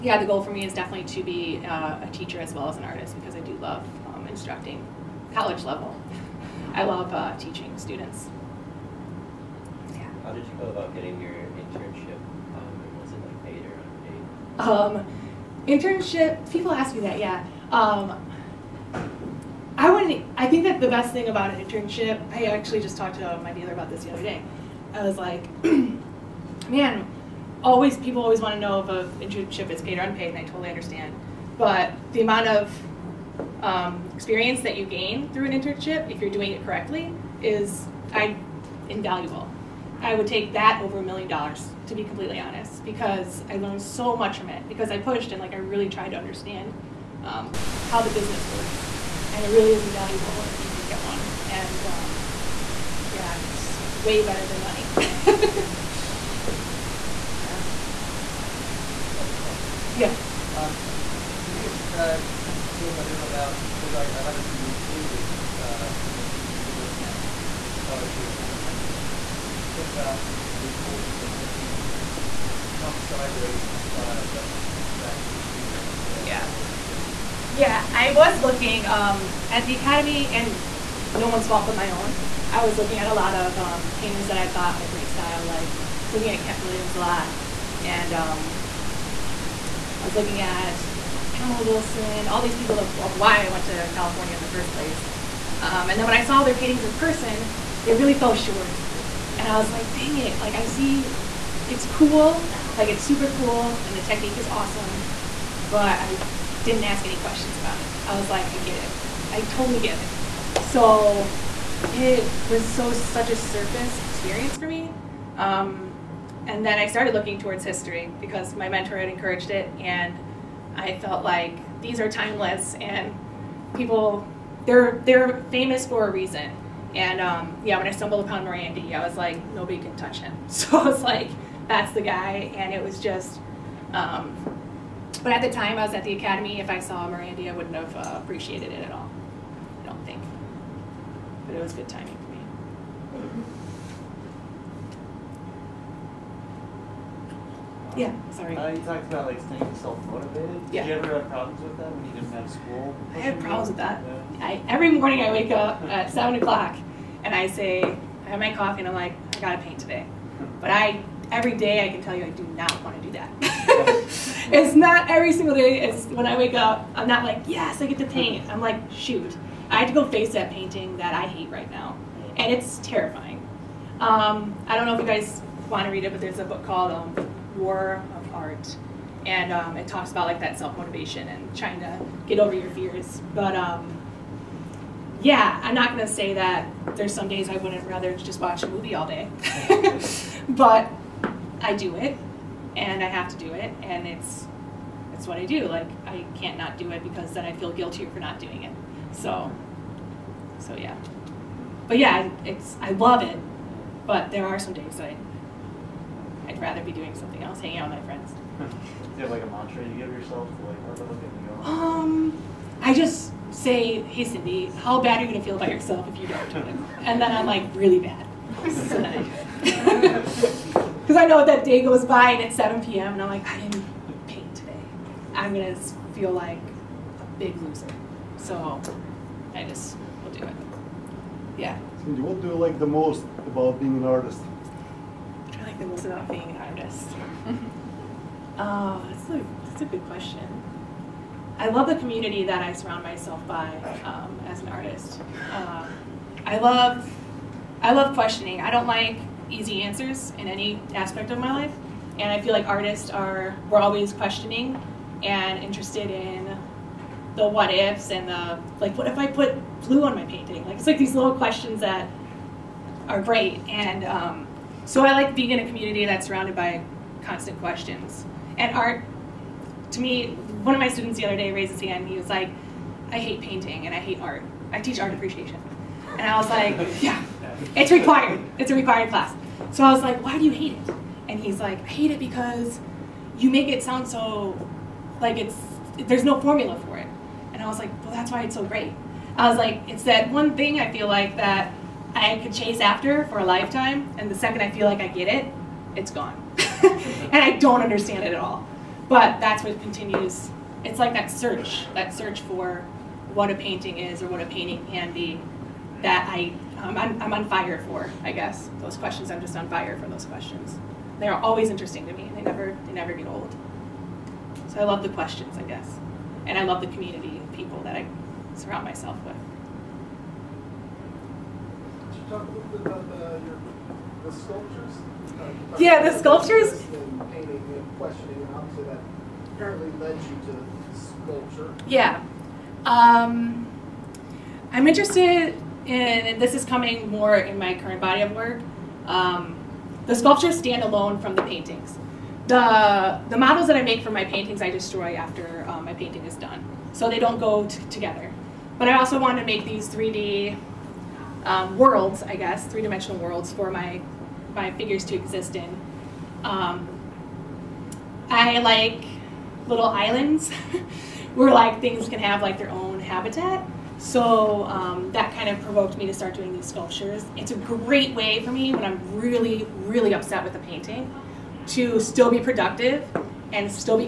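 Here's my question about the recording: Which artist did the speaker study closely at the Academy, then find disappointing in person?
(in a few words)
Kent Williams.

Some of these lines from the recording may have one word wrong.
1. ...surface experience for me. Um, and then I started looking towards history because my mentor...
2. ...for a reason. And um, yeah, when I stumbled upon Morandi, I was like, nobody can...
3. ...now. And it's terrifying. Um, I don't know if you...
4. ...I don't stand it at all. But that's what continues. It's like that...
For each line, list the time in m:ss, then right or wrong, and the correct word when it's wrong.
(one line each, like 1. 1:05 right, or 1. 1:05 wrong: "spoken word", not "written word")
1. 1:53 right
2. 2:05 right
3. 2:51 right
4. 4:57 wrong: "understand", not "stand".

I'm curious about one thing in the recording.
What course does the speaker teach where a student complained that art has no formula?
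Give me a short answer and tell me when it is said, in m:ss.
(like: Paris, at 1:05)
Art appreciation, at 4:34.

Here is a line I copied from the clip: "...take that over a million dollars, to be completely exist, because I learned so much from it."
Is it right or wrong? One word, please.
wrong.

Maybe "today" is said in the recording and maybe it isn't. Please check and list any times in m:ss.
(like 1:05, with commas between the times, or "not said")
2:39, 3:44.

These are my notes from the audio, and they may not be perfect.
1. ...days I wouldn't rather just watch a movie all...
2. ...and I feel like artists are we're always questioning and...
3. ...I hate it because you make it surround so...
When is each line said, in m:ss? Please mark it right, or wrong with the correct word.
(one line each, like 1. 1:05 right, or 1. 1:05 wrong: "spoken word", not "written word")
1. 3:07 right
2. 4:12 right
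3. 4:41 wrong: "sound", not "surround".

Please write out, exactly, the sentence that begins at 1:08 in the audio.
Can you talk about the importance of looking not sideways for style, but maybe back in history and elsewhere yeah.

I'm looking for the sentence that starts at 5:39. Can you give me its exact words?
Um, the sculptures stand alone from the paintings.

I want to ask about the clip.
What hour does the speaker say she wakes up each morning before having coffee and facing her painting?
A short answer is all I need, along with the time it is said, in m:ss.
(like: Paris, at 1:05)
7 o'clock, at 2:36.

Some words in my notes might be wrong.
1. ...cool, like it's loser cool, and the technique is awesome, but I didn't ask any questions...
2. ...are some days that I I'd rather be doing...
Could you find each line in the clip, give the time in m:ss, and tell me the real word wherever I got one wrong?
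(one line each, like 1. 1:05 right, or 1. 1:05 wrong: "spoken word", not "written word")
1. 1:41 wrong: "super", not "loser"
2. 3:24 right.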